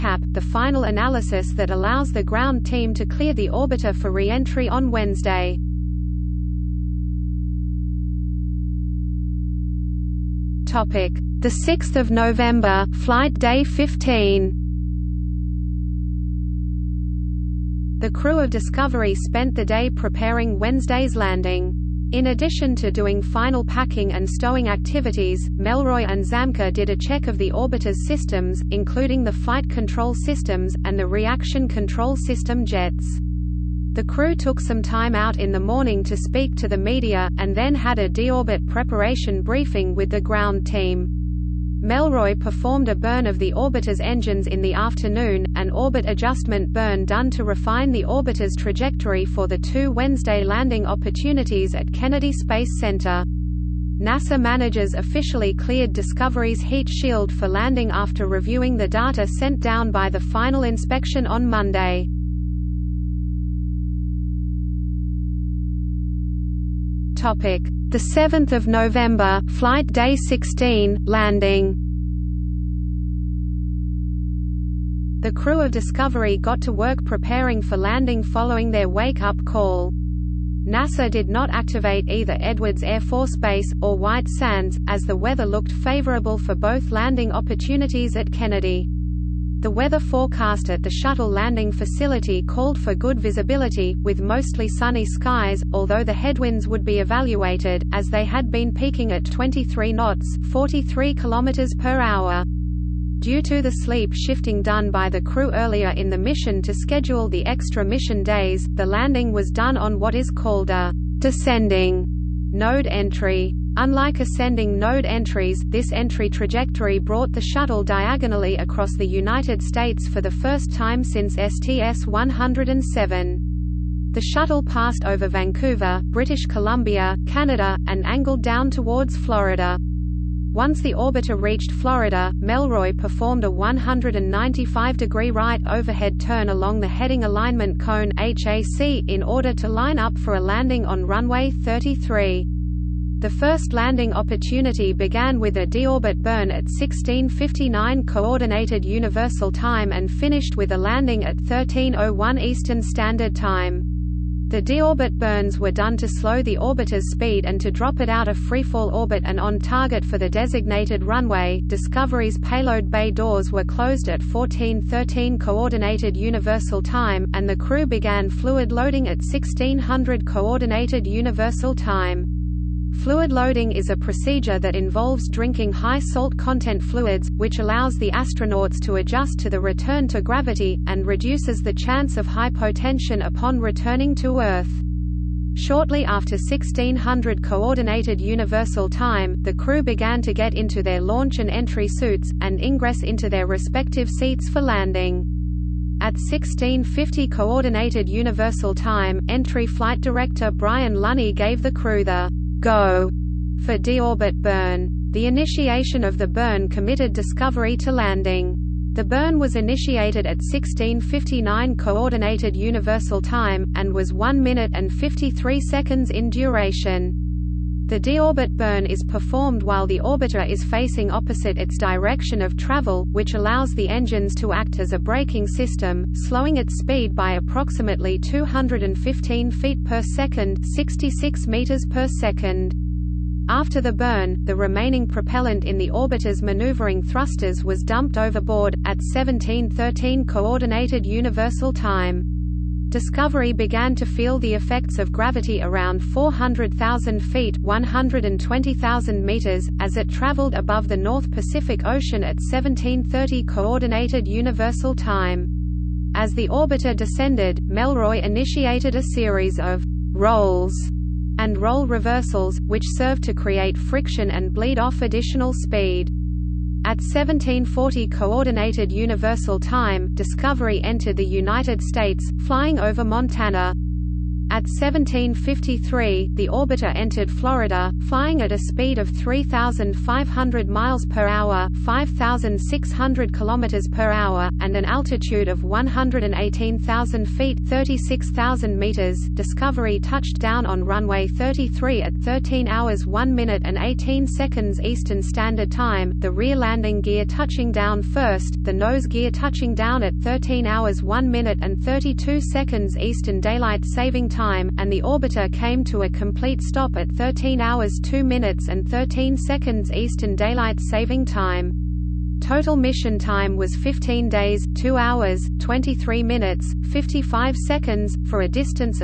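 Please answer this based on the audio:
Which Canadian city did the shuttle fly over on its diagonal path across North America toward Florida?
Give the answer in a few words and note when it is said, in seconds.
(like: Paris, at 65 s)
Vancouver, at 125 s.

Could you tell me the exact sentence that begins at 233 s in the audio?
After the burn, the remaining propellant in the orbiter's maneuvering thrusters was dumped overboard, at 1713 Coordinated Universal Time.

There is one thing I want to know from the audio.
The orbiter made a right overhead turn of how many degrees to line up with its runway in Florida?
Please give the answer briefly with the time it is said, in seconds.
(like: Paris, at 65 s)
195 degrees, at 133 s.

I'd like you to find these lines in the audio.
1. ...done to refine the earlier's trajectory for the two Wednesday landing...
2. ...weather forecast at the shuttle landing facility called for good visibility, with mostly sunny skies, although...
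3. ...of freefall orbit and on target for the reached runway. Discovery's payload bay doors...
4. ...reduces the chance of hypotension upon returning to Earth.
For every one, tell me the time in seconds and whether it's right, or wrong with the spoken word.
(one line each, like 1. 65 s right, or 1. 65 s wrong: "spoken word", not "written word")
1. 47 s wrong: "orbiter", not "earlier"
2. 89 s right
3. 158 s wrong: "designated", not "reached"
4. 181 s right.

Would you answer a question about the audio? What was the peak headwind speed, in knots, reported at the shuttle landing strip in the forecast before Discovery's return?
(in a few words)
23 knots.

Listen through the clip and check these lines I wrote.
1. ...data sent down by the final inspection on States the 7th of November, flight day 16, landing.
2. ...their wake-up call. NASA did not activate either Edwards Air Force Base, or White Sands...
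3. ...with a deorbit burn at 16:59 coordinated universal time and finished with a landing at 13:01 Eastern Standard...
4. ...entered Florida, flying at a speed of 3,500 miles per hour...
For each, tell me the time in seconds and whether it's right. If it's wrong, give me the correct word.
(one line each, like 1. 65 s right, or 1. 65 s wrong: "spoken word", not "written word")
1. 58 s wrong: "Monday", not "States"
2. 78 s right
3. 145 s right
4. 276 s right.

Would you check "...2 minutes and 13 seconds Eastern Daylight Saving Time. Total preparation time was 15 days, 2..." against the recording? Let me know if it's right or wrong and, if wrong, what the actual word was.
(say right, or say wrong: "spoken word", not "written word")
wrong: "mission", not "preparation".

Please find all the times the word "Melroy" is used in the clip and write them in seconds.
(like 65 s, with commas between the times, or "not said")
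25 s, 41 s, 132 s, 257 s.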